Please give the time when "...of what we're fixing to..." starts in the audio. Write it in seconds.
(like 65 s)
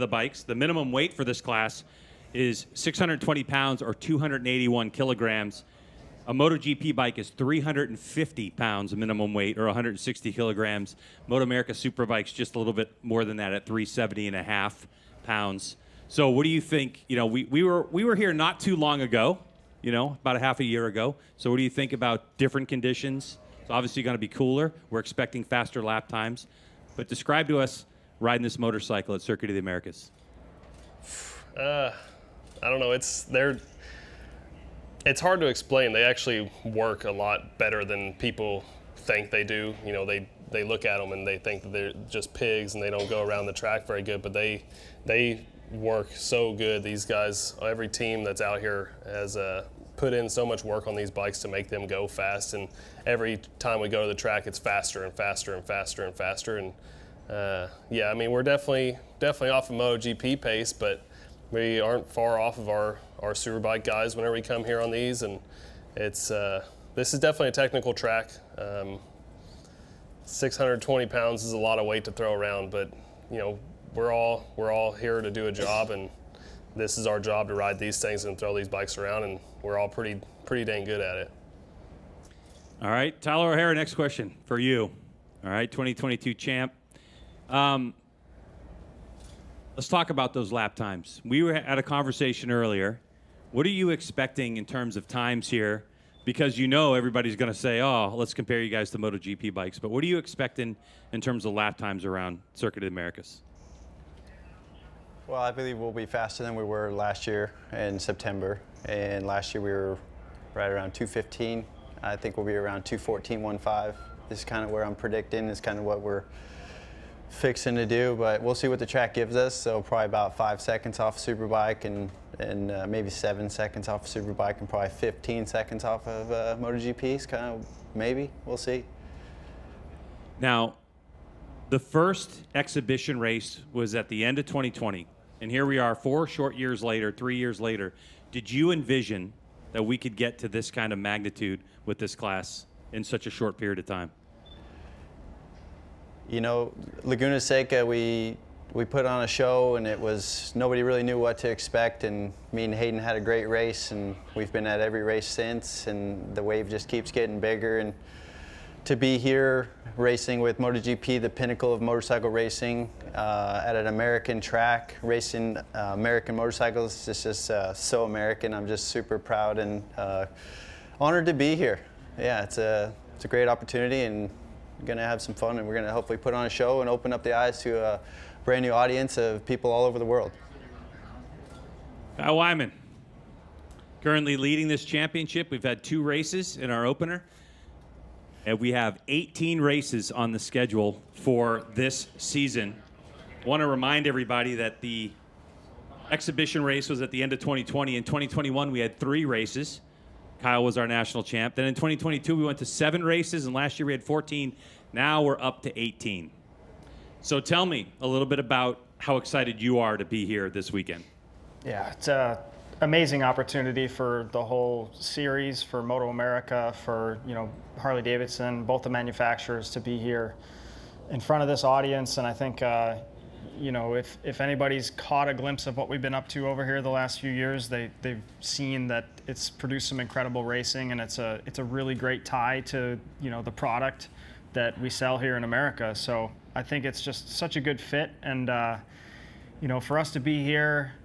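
115 s.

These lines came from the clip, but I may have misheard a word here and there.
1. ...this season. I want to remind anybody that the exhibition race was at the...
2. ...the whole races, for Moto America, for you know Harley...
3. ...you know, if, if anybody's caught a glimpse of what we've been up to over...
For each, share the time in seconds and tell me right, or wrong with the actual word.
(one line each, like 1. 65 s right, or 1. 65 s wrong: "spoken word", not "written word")
1. 191 s wrong: "everybody", not "anybody"
2. 214 s wrong: "series", not "races"
3. 223 s right.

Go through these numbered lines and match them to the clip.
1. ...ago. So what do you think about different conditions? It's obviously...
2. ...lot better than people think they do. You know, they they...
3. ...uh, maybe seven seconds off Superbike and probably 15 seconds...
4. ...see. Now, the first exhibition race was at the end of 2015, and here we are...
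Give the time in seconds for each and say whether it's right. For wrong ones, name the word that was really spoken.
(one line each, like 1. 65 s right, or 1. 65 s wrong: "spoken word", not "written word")
1. 20 s right
2. 37 s right
3. 122 s right
4. 128 s wrong: "2020", not "2015".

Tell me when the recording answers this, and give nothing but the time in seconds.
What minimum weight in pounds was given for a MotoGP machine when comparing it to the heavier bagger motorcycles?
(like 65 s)
7 s.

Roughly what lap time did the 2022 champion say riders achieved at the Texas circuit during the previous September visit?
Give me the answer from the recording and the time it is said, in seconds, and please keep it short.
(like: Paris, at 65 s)
2:15, at 110 s.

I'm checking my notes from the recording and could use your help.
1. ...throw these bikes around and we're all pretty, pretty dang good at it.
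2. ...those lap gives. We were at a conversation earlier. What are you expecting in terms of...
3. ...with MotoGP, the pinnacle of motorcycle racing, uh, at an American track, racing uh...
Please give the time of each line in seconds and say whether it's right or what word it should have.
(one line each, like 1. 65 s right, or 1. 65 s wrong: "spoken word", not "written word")
1. 78 s right
2. 90 s wrong: "times", not "gives"
3. 160 s right.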